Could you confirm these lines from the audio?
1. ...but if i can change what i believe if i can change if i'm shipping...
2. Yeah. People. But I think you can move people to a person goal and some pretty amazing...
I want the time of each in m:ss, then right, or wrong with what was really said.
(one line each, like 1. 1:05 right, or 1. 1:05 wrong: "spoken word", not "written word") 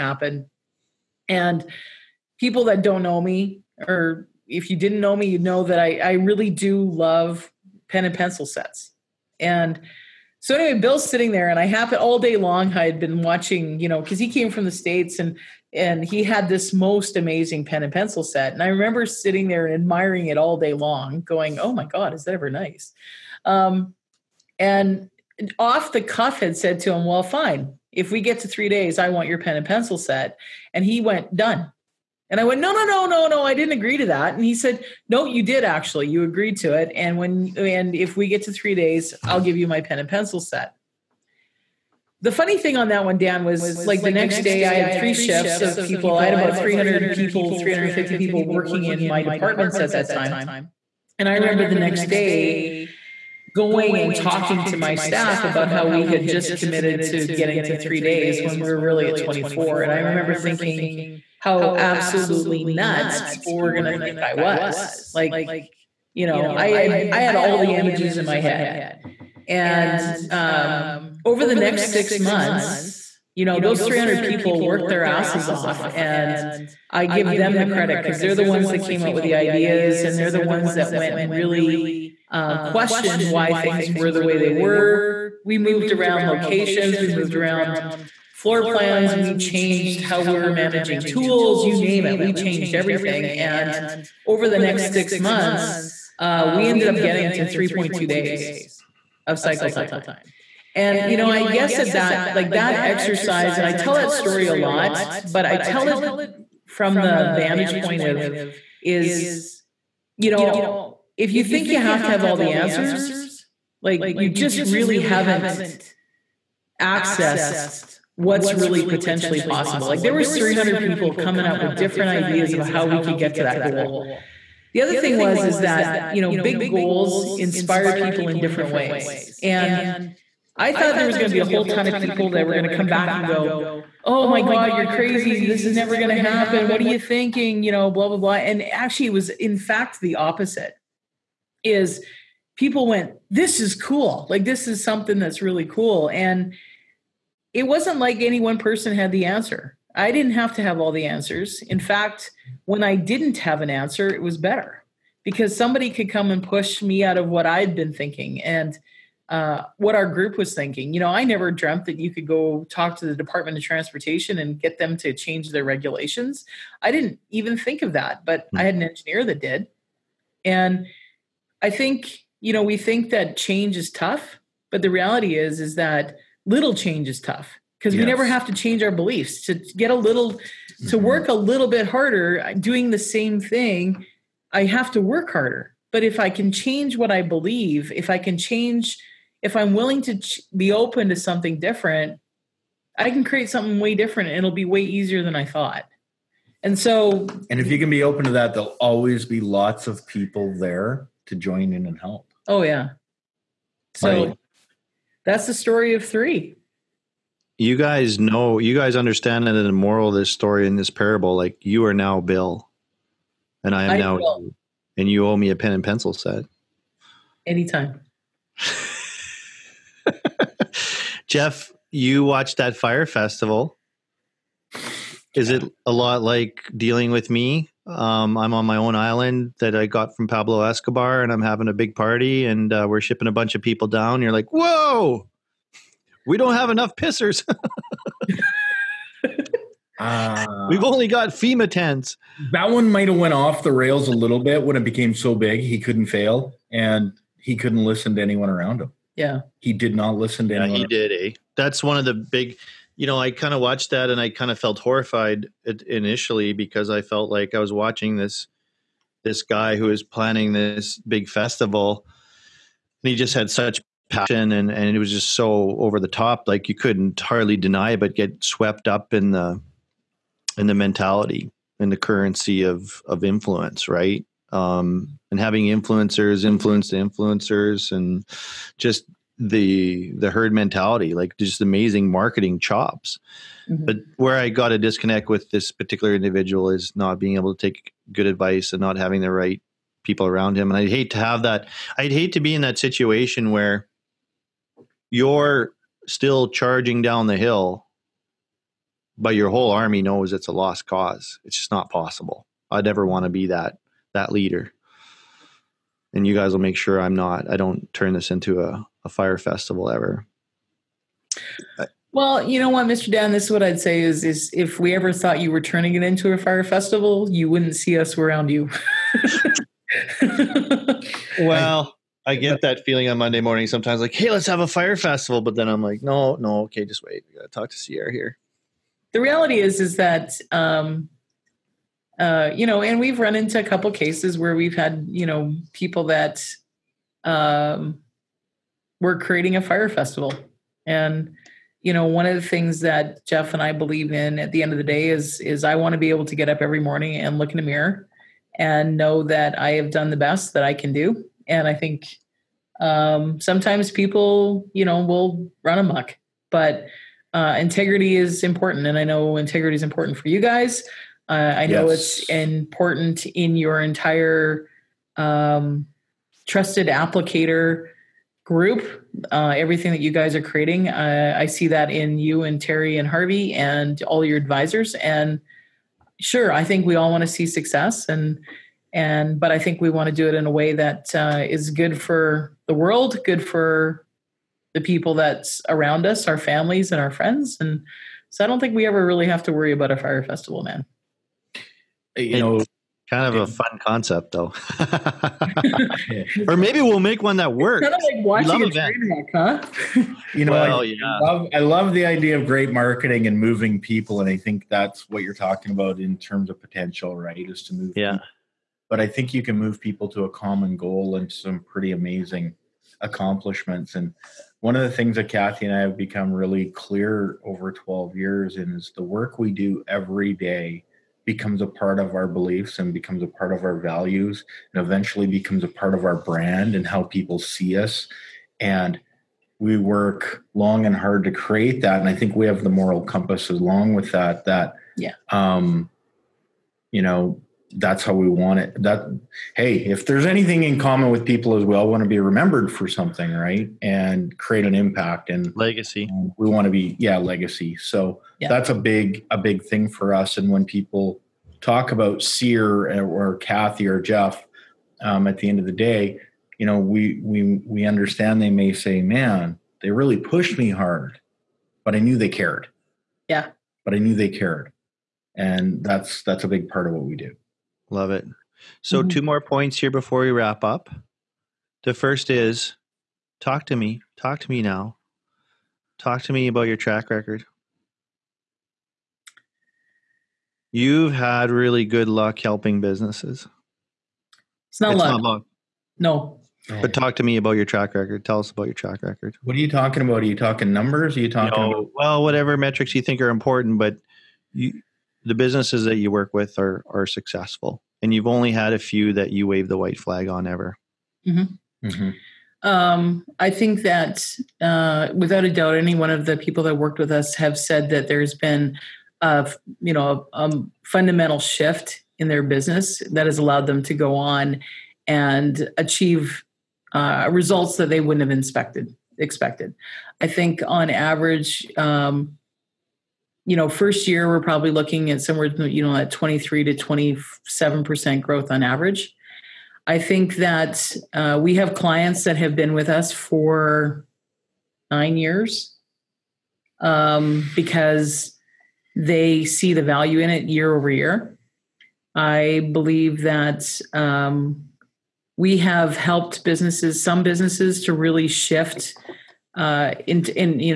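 1. 3:05 wrong: "willing", not "shipping"
2. 6:47 wrong: "common", not "person".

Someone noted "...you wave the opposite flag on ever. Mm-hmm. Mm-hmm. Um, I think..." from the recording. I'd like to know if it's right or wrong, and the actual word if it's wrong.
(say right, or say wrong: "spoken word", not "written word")
wrong: "white", not "opposite".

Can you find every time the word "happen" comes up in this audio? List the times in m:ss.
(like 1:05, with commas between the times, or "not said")
0:11, 2:16.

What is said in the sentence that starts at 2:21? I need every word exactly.
Is people went, "This is cool.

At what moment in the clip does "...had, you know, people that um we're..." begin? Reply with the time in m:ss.
5:34.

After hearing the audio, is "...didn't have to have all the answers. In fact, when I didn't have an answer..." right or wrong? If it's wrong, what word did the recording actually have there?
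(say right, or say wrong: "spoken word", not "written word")
right.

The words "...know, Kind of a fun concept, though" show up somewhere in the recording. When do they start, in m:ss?
6:32.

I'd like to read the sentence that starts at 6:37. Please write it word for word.
It's kind of like watching a train wreck, huh?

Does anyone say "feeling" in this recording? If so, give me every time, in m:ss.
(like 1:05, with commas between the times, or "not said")
5:22.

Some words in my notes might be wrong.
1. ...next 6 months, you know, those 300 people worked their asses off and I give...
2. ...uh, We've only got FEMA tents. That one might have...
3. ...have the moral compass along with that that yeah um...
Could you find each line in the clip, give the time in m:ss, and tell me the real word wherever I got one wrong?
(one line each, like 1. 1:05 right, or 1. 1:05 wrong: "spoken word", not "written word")
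1. 1:11 right
2. 3:59 right
3. 7:12 right.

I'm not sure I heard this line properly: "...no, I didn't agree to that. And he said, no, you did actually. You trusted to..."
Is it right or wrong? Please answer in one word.
wrong.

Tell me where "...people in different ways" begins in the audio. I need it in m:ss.
2:07.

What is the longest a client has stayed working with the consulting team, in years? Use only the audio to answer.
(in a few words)
9.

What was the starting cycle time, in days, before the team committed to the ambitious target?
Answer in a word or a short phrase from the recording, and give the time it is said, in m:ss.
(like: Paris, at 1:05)
24, at 0:59.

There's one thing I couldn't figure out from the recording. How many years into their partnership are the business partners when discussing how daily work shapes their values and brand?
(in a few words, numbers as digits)
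12.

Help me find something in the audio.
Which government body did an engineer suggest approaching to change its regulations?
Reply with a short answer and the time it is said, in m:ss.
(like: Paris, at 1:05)
Department of Transportation, at 2:43.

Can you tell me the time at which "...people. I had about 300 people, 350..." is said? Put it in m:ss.
0:45.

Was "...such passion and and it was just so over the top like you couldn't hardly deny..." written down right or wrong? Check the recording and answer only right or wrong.
right.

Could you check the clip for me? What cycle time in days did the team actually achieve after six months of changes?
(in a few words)
3.2 days.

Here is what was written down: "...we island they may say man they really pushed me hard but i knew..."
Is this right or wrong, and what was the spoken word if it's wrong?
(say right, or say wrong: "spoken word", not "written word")
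wrong: "understand", not "island".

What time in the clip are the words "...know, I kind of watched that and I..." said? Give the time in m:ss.
4:13.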